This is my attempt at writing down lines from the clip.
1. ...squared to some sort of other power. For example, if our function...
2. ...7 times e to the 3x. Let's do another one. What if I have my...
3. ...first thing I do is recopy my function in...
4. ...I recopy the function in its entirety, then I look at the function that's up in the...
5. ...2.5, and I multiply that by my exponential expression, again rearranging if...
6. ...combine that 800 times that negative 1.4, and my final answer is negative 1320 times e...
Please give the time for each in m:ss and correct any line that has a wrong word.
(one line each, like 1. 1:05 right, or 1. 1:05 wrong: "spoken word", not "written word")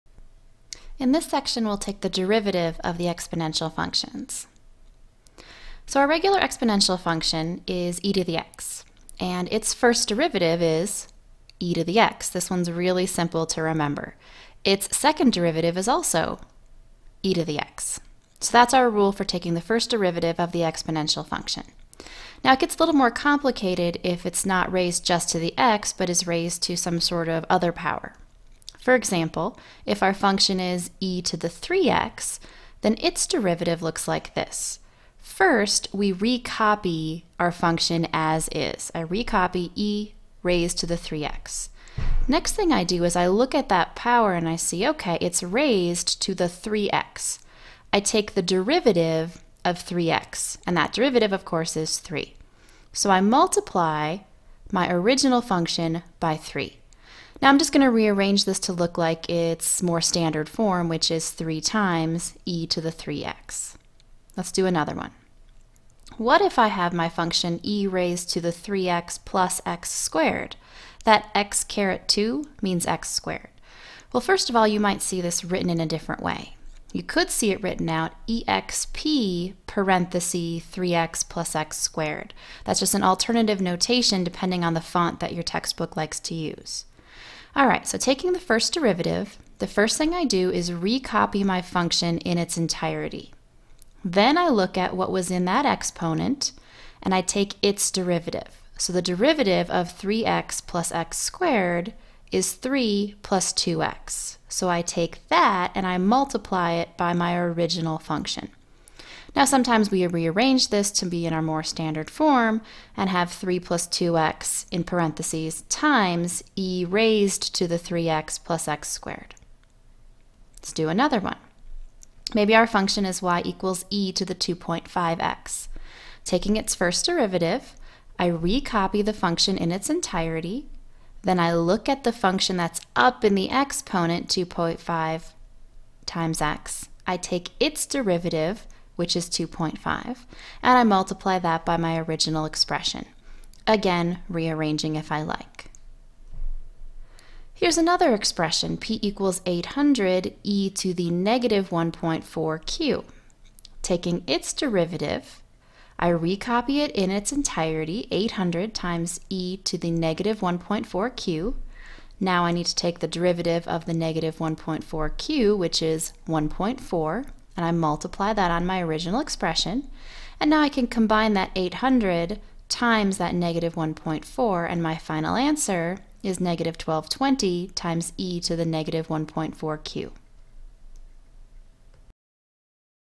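1. 0:26 wrong: "raised", not "squared"
2. 1:01 wrong: "3", not "7"
3. 1:29 right
4. 2:08 right
5. 2:19 wrong: "original", not "exponential"
6. 2:50 wrong: "1220", not "1320".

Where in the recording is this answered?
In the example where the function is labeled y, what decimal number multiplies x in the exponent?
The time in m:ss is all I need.
2:04.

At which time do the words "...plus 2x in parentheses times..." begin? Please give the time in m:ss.
1:53.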